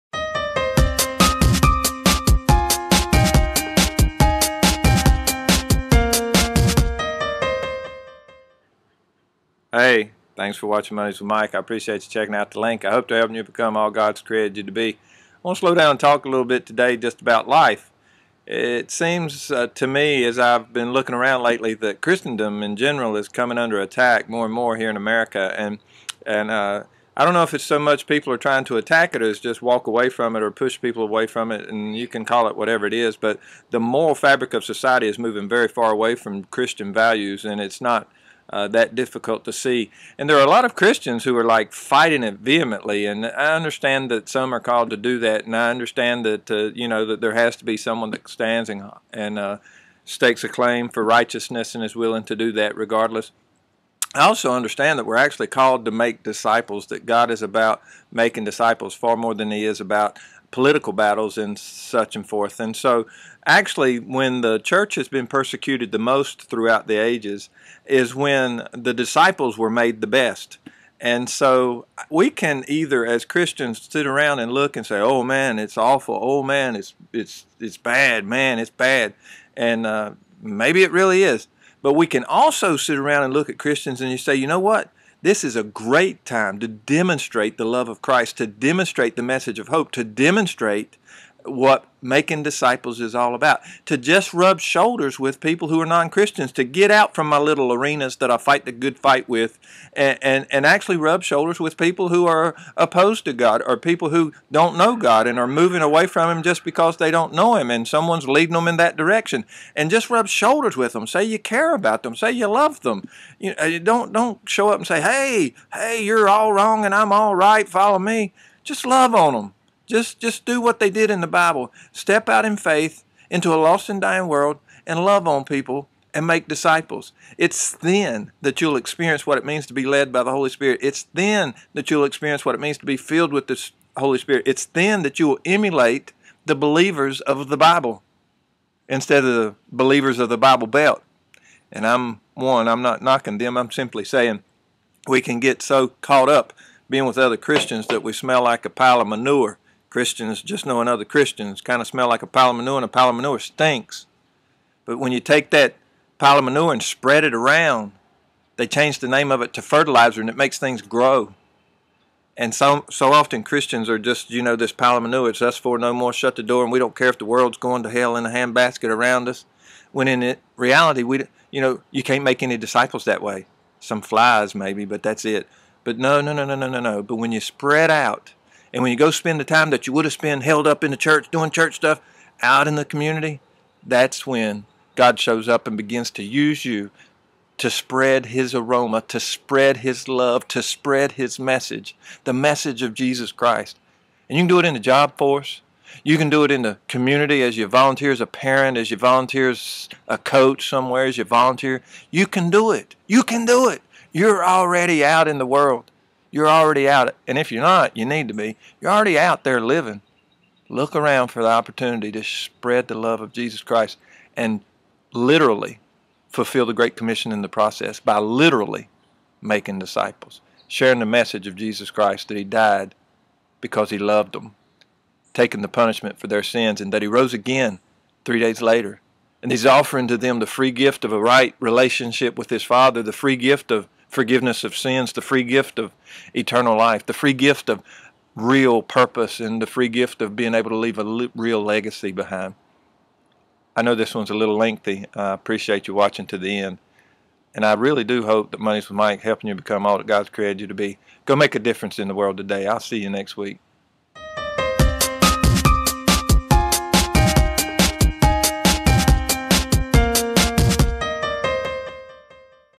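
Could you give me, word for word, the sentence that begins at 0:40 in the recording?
And there are a lot of Christians who are like fighting it vehemently.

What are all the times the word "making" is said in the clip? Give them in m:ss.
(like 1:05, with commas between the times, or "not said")
0:58, 1:32, 3:39.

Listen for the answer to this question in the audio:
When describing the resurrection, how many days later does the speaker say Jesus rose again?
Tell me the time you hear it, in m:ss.
3:48.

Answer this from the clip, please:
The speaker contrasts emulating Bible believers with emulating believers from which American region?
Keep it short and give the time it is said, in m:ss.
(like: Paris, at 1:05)
the Bible Belt, at 2:20.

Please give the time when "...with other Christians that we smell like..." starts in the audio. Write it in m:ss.
2:27.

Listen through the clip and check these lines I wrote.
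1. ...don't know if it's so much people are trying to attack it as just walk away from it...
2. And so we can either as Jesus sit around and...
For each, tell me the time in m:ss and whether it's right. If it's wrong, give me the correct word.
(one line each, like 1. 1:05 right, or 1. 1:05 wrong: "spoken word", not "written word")
1. 0:27 right
2. 1:10 wrong: "Christians", not "Jesus".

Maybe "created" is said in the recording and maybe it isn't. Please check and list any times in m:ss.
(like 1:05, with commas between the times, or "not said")
0:14, 4:10.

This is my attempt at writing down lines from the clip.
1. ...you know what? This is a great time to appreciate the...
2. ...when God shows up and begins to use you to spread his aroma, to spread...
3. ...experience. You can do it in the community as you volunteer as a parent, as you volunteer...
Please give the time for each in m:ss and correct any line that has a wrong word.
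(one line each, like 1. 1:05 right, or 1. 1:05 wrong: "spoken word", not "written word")
1. 1:24 wrong: "demonstrate", not "appreciate"
2. 3:04 right
3. 3:15 wrong: "force", not "experience".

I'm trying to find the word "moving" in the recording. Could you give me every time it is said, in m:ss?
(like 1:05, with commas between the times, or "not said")
0:35, 1:45.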